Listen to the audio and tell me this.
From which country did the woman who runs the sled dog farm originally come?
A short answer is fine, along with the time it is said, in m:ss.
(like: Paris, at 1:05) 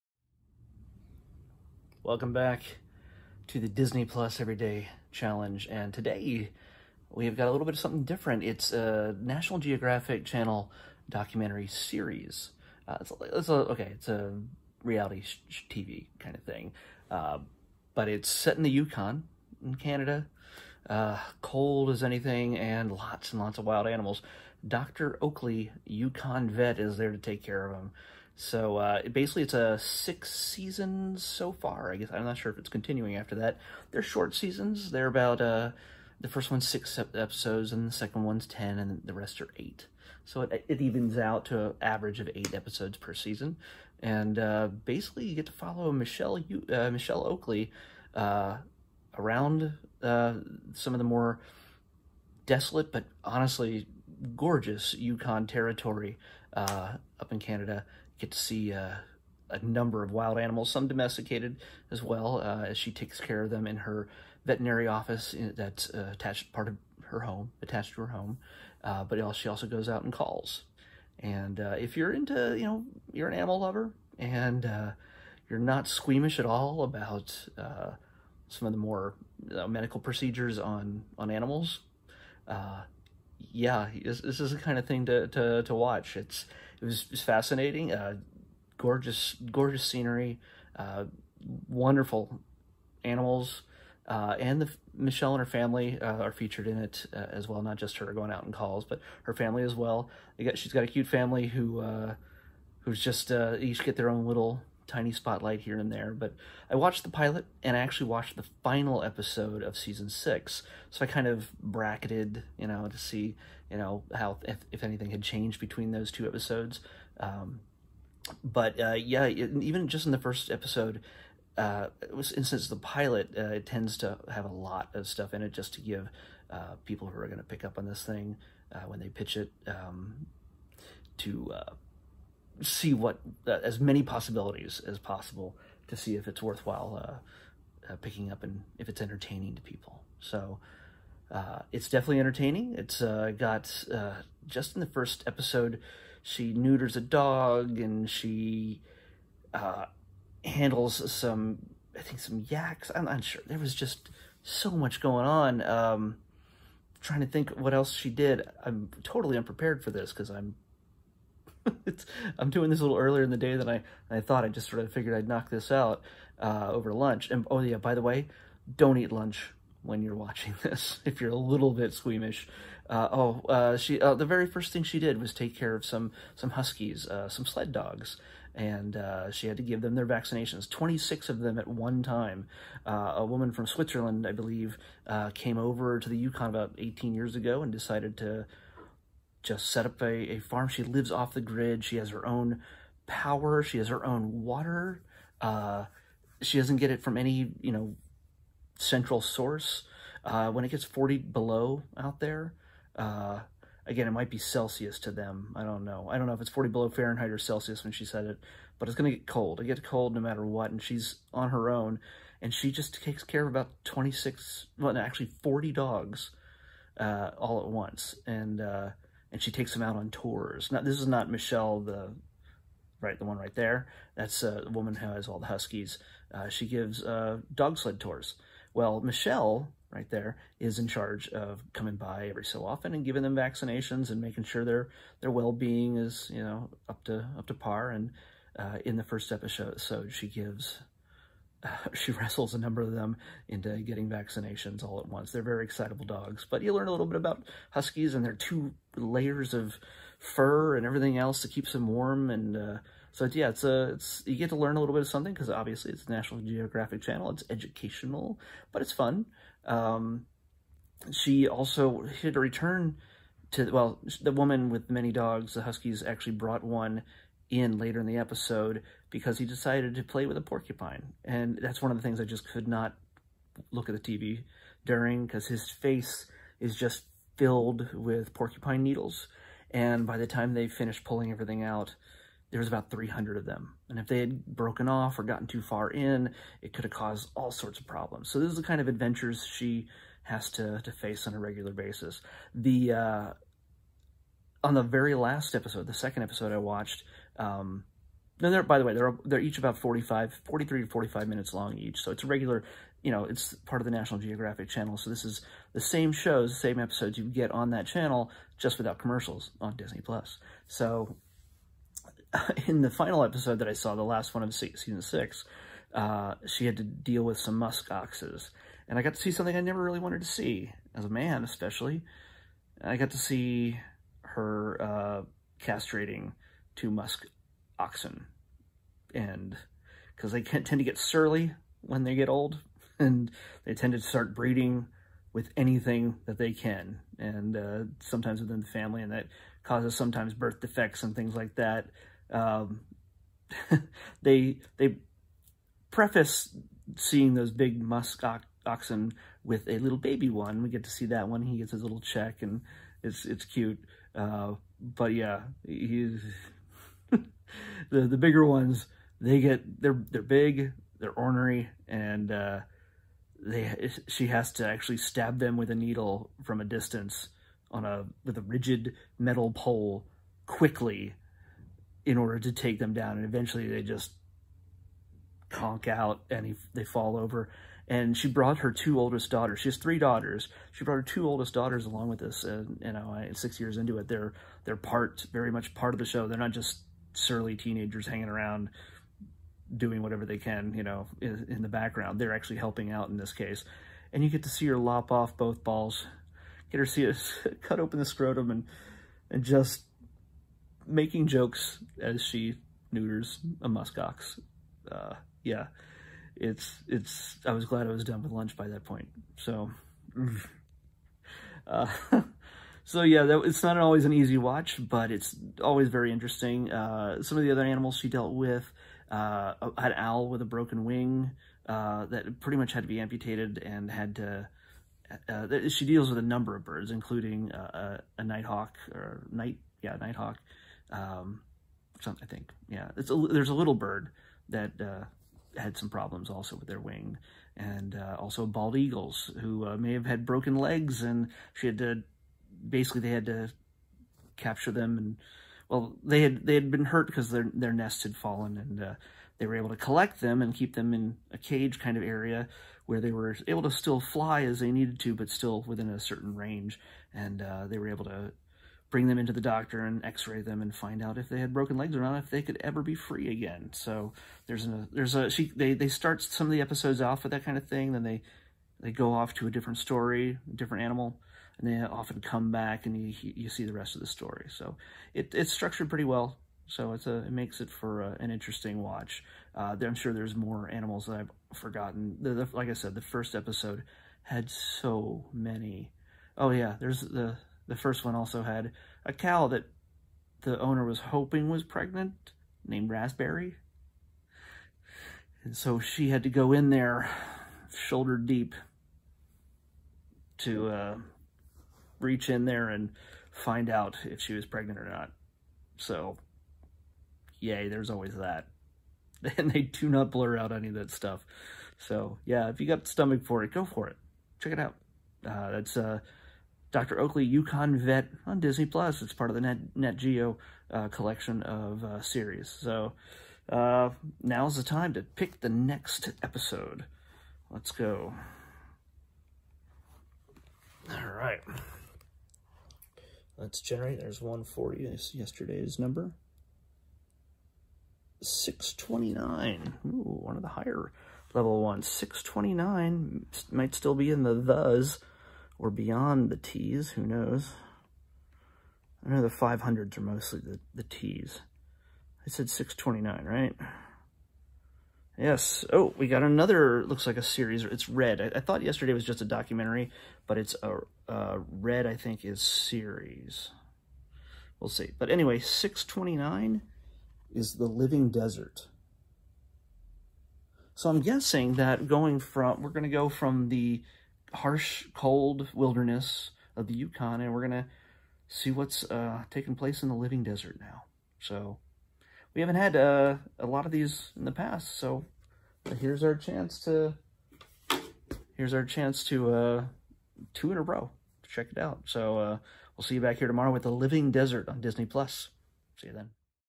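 Switzerland, at 3:03.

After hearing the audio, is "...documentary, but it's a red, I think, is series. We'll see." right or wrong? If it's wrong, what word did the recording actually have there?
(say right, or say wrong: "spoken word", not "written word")
right.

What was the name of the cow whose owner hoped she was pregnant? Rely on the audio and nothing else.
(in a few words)
Raspberry.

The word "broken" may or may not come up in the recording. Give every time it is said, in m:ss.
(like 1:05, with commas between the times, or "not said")
4:44, 7:00, 7:20, 7:41.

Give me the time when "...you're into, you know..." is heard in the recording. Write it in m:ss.
1:11.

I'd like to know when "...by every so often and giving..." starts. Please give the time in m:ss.
3:51.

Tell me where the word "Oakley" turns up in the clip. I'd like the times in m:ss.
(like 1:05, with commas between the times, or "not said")
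0:25, 0:47, 8:36.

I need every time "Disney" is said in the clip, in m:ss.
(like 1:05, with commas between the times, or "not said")
0:03, 5:09, 8:38, 9:54.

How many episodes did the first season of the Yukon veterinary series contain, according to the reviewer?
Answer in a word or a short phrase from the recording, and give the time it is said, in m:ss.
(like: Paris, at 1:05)
6, at 0:36.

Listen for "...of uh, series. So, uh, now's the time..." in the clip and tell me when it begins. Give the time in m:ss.
8:41.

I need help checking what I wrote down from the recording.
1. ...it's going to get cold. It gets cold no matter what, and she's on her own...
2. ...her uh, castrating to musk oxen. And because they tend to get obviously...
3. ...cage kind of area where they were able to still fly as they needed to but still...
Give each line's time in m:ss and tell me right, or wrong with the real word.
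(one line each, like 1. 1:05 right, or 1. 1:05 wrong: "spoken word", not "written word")
1. 3:28 right
2. 5:24 wrong: "surly", not "obviously"
3. 7:31 right.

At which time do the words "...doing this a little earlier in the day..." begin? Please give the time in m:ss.
2:42.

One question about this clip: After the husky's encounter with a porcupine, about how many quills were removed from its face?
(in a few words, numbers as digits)
300.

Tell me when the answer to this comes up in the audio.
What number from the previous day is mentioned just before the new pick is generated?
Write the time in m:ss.
8:54.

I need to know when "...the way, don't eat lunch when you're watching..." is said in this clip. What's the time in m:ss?
2:47.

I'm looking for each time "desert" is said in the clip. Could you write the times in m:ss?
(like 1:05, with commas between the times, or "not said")
9:28, 9:40, 9:54.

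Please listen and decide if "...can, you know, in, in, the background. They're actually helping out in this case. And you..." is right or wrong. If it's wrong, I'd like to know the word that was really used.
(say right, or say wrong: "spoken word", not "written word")
right.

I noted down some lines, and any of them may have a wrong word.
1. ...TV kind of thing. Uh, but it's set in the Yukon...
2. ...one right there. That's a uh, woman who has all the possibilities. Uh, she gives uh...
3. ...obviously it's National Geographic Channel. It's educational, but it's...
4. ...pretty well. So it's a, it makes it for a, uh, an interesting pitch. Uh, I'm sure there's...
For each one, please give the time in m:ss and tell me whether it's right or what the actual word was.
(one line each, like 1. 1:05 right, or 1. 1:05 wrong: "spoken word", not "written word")
1. 0:15 right
2. 3:43 wrong: "huskies", not "possibilities"
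3. 4:15 right
4. 7:55 wrong: "watch", not "pitch".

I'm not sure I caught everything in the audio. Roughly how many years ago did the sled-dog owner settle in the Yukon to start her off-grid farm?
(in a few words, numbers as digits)
18.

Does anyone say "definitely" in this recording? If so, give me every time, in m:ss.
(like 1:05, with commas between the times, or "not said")
2:21.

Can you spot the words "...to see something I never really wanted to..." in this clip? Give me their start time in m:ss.
5:19.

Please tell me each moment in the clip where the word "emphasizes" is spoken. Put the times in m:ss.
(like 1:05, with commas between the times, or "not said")
not said.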